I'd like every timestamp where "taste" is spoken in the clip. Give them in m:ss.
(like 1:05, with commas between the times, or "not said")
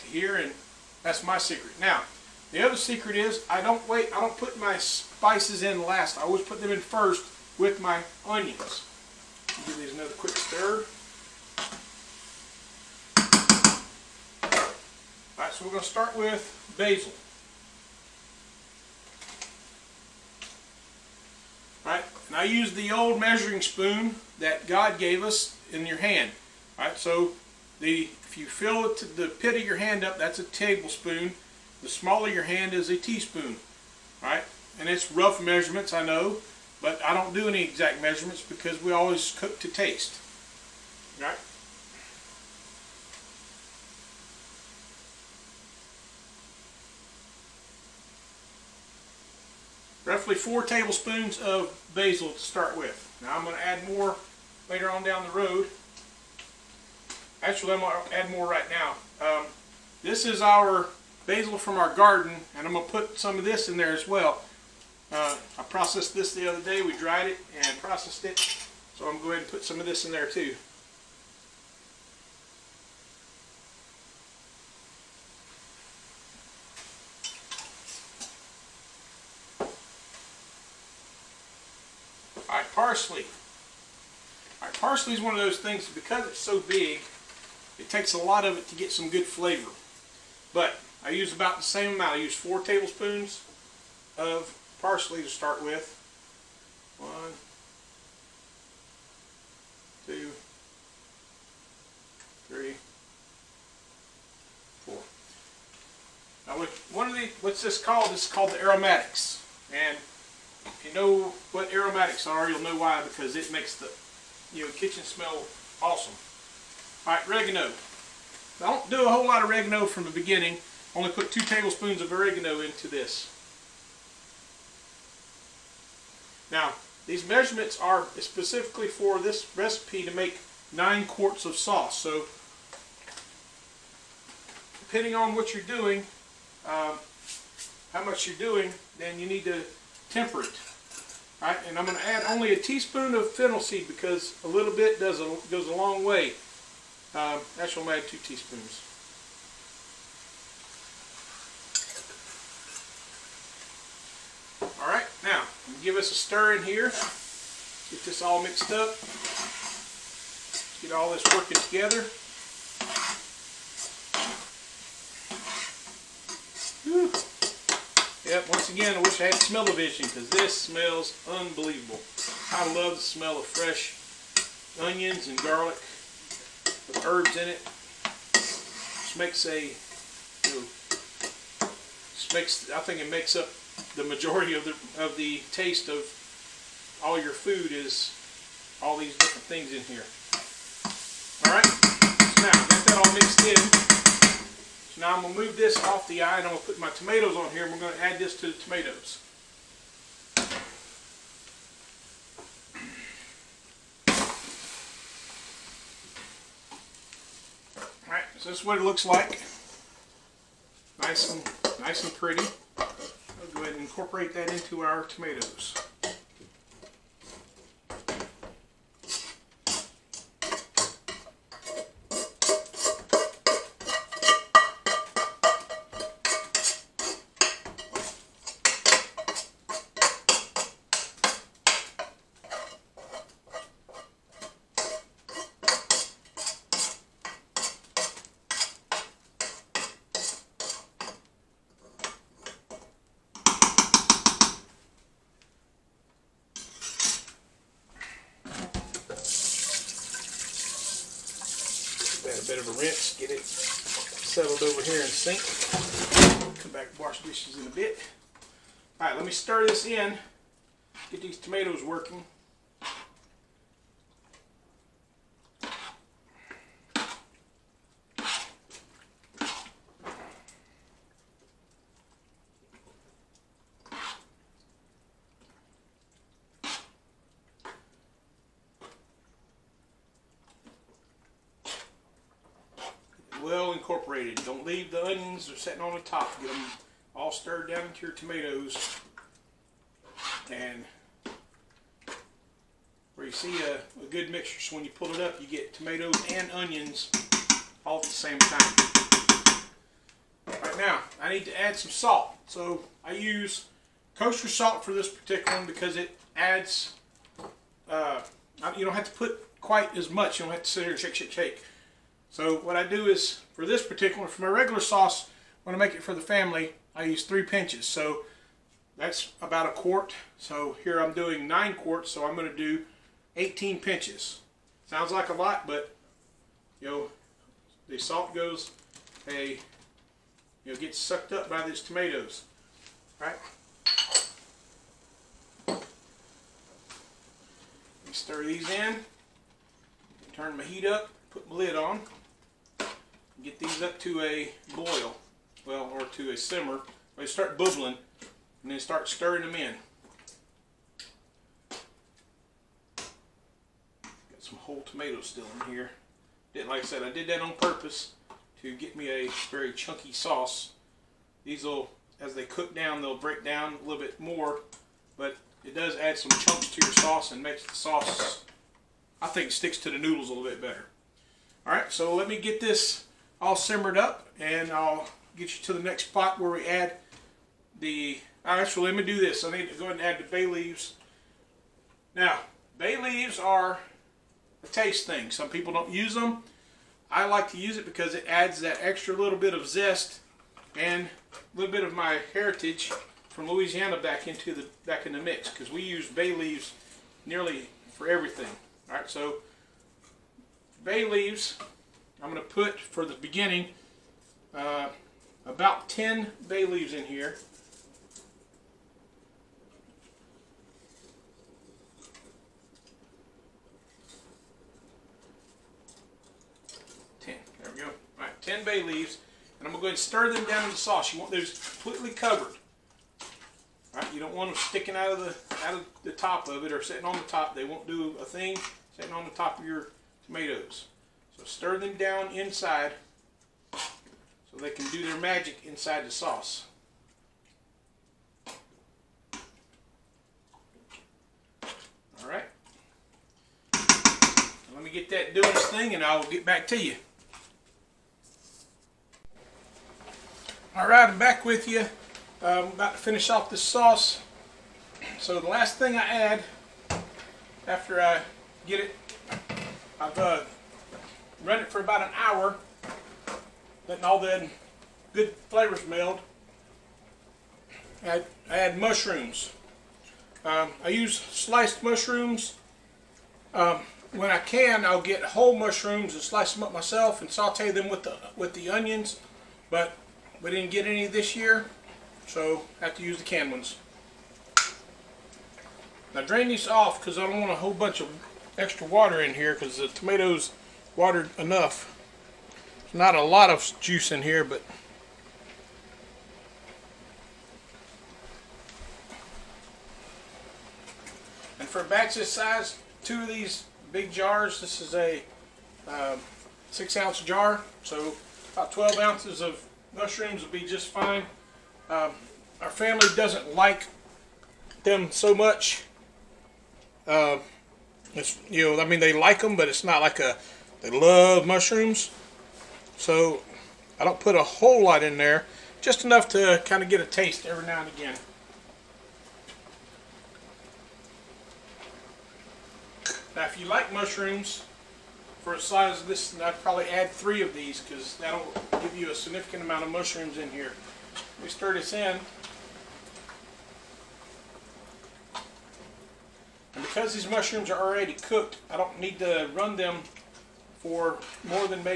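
0:39, 3:05, 6:24, 8:47.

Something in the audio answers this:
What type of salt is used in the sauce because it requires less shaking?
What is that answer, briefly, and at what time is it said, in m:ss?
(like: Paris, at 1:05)
Kosher salt, at 5:04.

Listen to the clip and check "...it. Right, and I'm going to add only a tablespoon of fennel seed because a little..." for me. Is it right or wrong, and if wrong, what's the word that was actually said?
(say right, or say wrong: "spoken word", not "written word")
wrong: "teaspoon", not "tablespoon".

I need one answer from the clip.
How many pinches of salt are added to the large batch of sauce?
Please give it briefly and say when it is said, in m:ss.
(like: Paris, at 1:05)
18, at 5:23.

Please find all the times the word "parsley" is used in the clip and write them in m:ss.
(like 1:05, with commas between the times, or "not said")
1:25, 1:34.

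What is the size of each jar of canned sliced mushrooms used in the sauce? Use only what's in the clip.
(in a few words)
6 ounces.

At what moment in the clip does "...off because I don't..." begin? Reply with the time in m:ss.
8:06.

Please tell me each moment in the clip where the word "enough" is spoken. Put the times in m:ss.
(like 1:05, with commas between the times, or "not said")
8:11, 8:46.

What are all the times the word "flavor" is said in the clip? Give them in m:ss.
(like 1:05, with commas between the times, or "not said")
1:29, 7:45.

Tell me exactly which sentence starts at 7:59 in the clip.
But we didn't get any this year, so I have to use the canned ones.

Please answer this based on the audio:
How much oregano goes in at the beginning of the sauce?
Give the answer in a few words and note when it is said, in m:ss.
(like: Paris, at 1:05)
2 tablespoons, at 2:01.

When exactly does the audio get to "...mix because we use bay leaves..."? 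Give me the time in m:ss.
6:35.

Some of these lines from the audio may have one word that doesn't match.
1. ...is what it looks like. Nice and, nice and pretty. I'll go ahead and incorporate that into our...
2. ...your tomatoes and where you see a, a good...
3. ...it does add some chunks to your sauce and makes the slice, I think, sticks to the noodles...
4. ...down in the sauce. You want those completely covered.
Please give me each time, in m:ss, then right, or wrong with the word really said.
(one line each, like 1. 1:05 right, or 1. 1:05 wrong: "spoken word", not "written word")
1. 3:28 right
2. 4:48 right
3. 6:05 wrong: "sauce", not "slice"
4. 7:00 right.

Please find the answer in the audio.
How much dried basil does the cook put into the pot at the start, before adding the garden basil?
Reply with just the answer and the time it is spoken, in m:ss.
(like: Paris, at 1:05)
4 tablespoons, at 0:50.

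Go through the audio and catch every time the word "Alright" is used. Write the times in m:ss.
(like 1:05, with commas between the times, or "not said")
3:11, 3:28, 6:18.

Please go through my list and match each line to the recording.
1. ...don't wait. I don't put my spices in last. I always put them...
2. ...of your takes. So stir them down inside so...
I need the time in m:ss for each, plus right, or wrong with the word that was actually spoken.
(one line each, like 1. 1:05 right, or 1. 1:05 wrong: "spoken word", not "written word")
1. 0:03 right
2. 7:09 wrong: "tomatoes", not "takes".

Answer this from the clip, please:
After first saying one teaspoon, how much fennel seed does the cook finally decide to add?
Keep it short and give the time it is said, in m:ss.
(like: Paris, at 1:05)
2 teaspoons, at 2:28.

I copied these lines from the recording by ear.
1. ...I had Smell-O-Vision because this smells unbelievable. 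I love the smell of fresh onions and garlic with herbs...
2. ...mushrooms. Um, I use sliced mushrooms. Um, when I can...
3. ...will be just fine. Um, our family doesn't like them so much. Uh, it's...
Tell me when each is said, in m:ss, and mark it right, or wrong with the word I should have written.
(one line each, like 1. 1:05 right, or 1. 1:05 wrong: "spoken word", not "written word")
1. 2:49 right
2. 7:48 right
3. 8:30 right.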